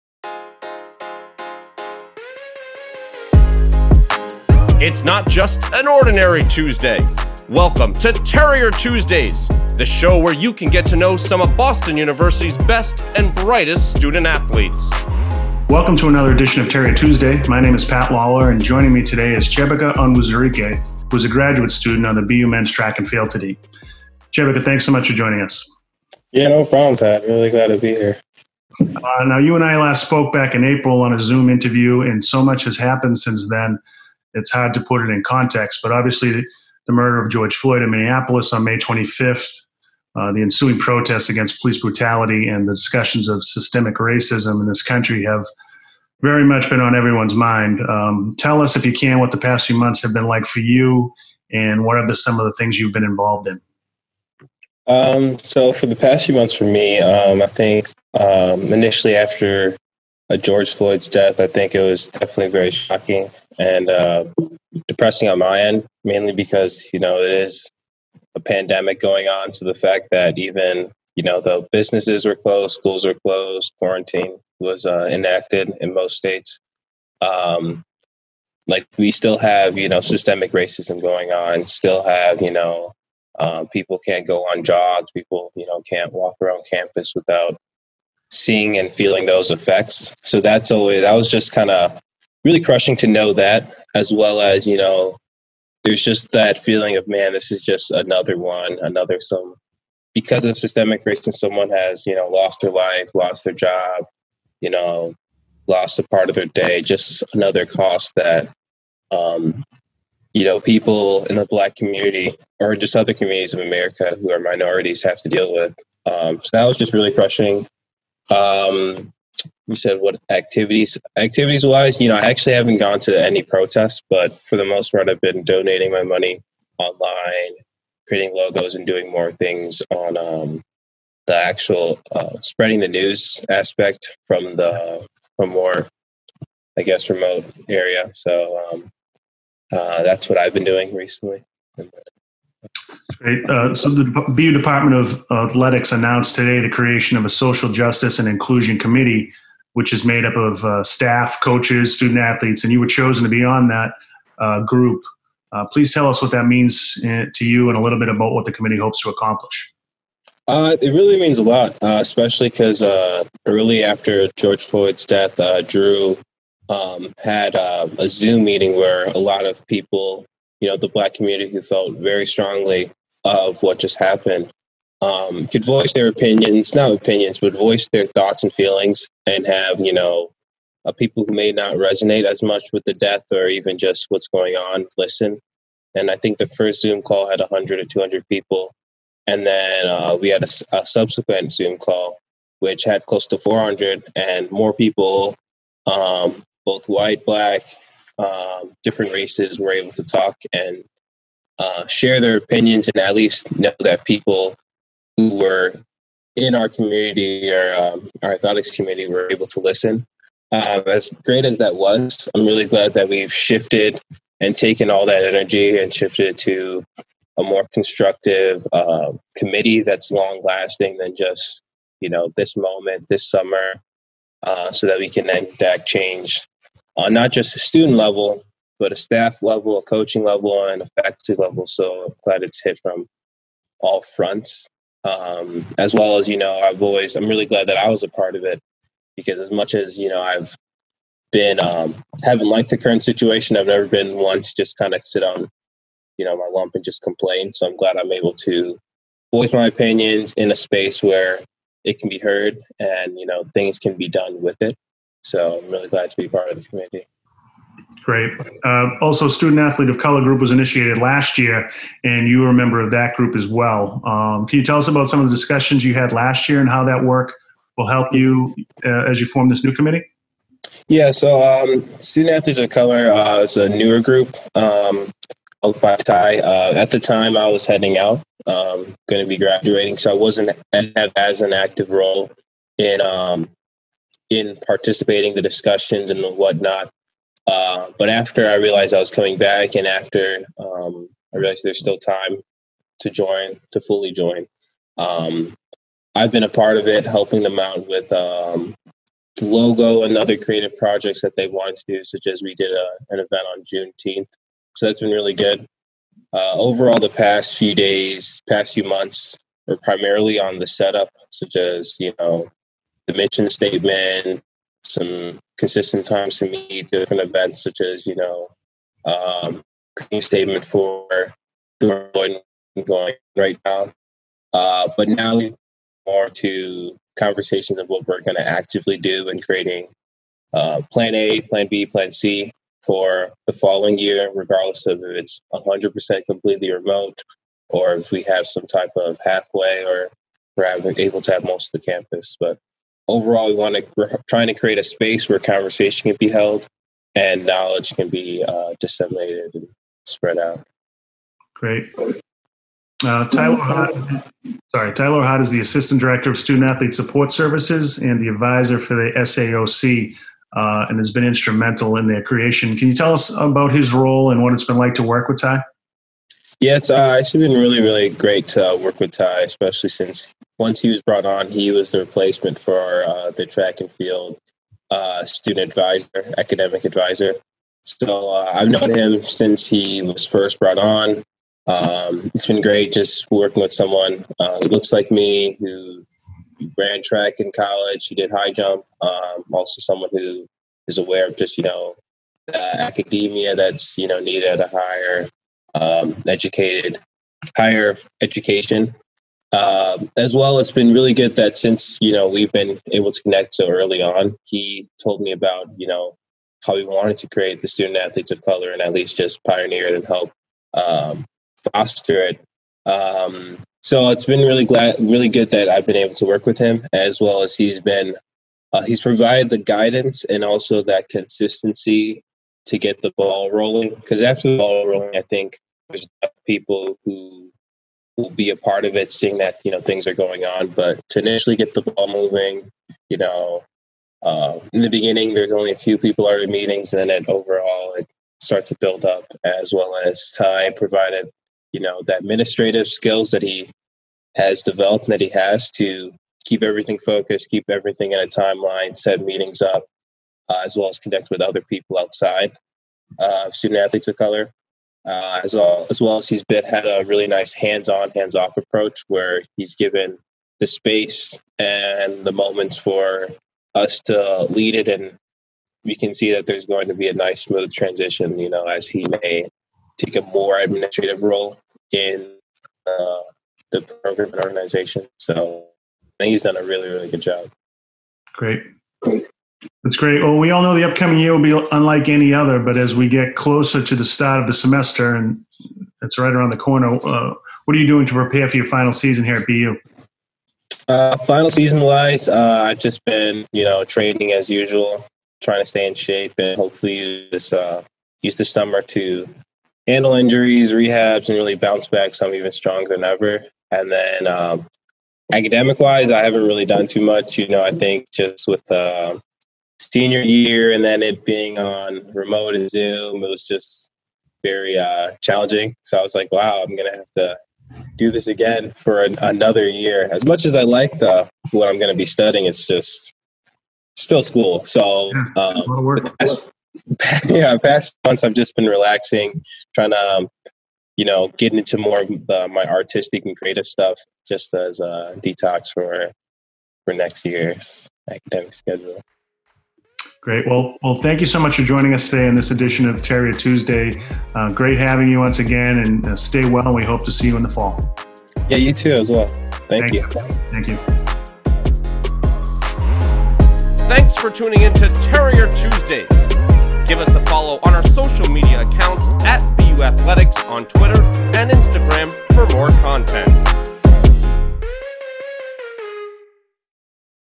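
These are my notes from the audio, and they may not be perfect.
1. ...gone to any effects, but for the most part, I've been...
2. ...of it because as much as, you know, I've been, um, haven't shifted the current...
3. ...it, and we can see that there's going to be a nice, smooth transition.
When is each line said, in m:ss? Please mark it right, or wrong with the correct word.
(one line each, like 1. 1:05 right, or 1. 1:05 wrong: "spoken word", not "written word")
1. 2:02 wrong: "protests", not "effects"
2. 3:58 wrong: "liked", not "shifted"
3. 7:44 right.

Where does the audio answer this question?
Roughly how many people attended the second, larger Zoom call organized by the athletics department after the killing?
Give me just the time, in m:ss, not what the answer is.
3:13.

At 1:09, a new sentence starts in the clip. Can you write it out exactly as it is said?
So the fact that even you know the businesses were closed, schools were closed, quarantine was uh, enacted in most states.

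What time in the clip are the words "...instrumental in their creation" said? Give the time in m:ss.
6:01.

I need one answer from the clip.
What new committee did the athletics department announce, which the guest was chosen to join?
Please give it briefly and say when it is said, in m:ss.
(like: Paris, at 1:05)
social justice and inclusion committee, at 2:27.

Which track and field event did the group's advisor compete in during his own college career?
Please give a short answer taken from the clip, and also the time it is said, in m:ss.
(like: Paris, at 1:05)
high jump, at 6:28.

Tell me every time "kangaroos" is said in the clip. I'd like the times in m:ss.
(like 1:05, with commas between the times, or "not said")
not said.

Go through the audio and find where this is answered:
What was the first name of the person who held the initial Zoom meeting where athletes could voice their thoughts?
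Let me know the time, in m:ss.
2:45.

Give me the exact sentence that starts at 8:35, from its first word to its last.
So I was like, wow, I'm going to have to do this again for an, another year.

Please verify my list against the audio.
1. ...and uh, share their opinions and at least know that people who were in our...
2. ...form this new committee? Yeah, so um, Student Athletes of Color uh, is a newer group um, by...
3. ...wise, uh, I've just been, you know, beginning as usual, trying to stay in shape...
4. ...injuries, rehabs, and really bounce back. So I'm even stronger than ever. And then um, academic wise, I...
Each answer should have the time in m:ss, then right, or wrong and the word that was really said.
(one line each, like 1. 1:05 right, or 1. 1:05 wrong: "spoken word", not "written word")
1. 3:20 right
2. 4:29 right
3. 8:11 wrong: "training", not "beginning"
4. 8:20 right.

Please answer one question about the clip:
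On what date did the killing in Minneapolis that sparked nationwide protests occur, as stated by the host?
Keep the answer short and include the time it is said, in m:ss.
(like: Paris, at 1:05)
May 25th, at 0:38.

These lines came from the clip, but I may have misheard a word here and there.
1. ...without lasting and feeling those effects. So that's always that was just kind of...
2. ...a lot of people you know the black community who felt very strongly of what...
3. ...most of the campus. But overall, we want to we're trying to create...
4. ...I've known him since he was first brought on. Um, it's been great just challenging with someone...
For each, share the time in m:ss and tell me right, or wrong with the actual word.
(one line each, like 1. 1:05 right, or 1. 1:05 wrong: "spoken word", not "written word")
1. 1:27 wrong: "seeing", not "lasting"
2. 2:49 right
3. 5:41 right
4. 6:18 wrong: "working", not "challenging".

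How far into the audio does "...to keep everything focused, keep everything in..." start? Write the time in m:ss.
7:25.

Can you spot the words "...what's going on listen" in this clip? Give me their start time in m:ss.
3:04.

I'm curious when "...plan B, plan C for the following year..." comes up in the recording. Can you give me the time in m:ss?
5:31.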